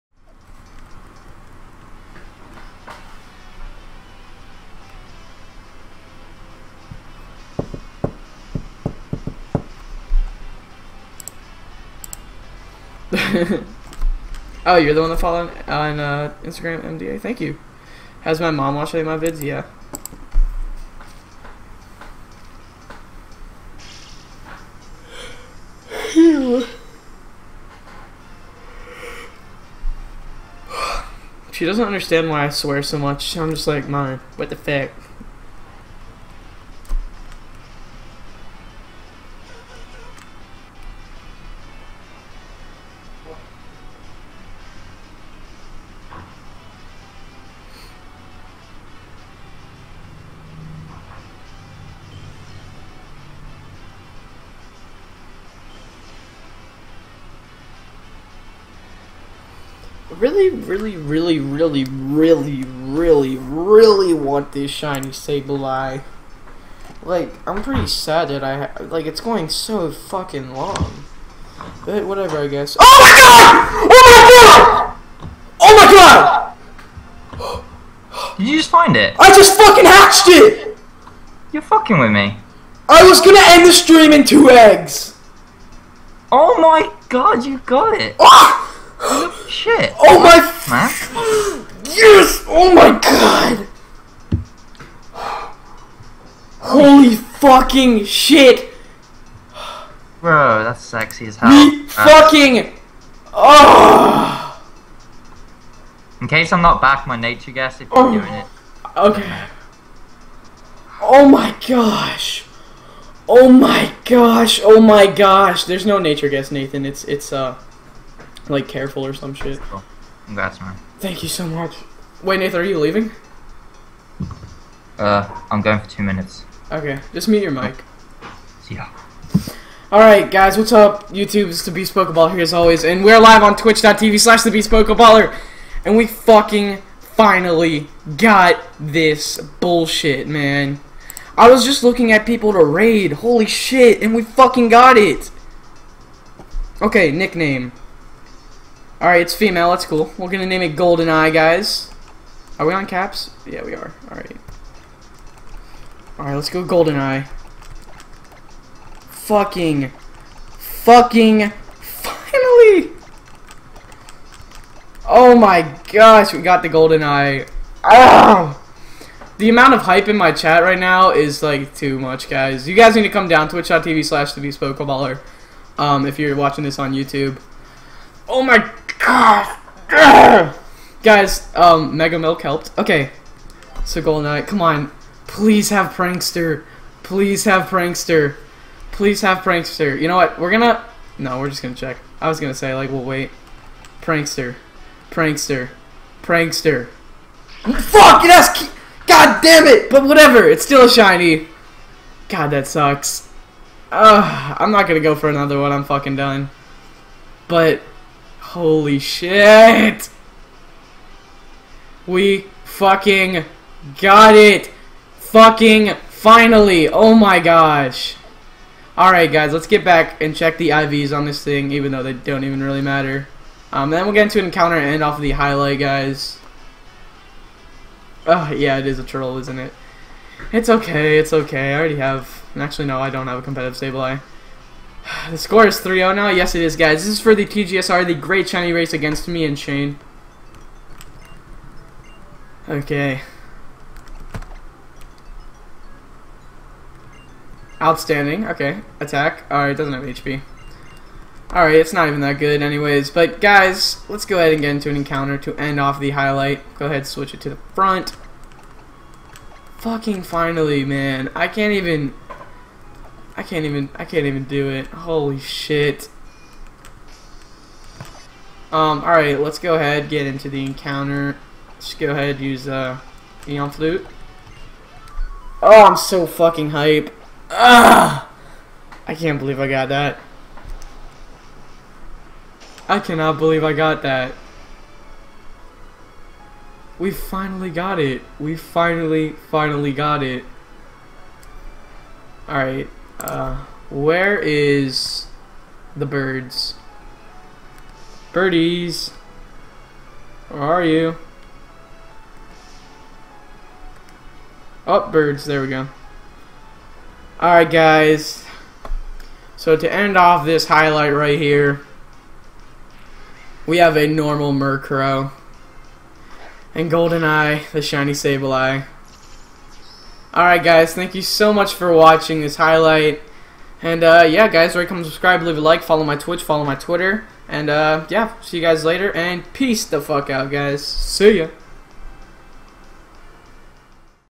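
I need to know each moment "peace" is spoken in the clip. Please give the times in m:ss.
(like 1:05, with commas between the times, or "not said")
5:29.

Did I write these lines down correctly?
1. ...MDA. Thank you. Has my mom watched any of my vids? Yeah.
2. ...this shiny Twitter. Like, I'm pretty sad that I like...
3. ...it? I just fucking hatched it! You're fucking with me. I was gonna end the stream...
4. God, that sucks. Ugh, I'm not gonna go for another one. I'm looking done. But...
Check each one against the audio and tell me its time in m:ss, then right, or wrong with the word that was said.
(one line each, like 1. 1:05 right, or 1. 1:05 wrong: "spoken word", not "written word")
1. 0:16 right
2. 1:04 wrong: "Sableye", not "Twitter"
3. 1:18 right
4. 3:22 wrong: "fucking", not "looking".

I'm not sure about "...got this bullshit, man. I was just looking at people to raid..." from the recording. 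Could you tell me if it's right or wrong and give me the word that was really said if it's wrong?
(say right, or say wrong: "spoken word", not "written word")
right.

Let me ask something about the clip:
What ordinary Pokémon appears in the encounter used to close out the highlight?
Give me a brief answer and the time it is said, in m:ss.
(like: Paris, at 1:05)
Murkrow, at 5:14.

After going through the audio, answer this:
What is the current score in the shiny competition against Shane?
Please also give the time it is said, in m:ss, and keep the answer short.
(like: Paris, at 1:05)
3-0, at 3:55.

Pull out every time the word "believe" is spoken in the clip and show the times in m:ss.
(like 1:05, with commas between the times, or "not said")
4:39, 4:43.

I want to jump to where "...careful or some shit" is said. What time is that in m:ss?
1:58.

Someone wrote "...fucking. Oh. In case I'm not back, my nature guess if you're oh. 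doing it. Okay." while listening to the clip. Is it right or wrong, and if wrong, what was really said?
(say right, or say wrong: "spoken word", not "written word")
right.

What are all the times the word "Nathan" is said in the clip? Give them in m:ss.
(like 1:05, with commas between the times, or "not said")
1:56, 2:02.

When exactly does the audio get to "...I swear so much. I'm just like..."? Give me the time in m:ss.
0:32.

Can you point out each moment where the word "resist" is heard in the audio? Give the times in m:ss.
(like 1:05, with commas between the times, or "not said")
not said.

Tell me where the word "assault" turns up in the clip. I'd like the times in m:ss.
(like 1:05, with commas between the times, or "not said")
not said.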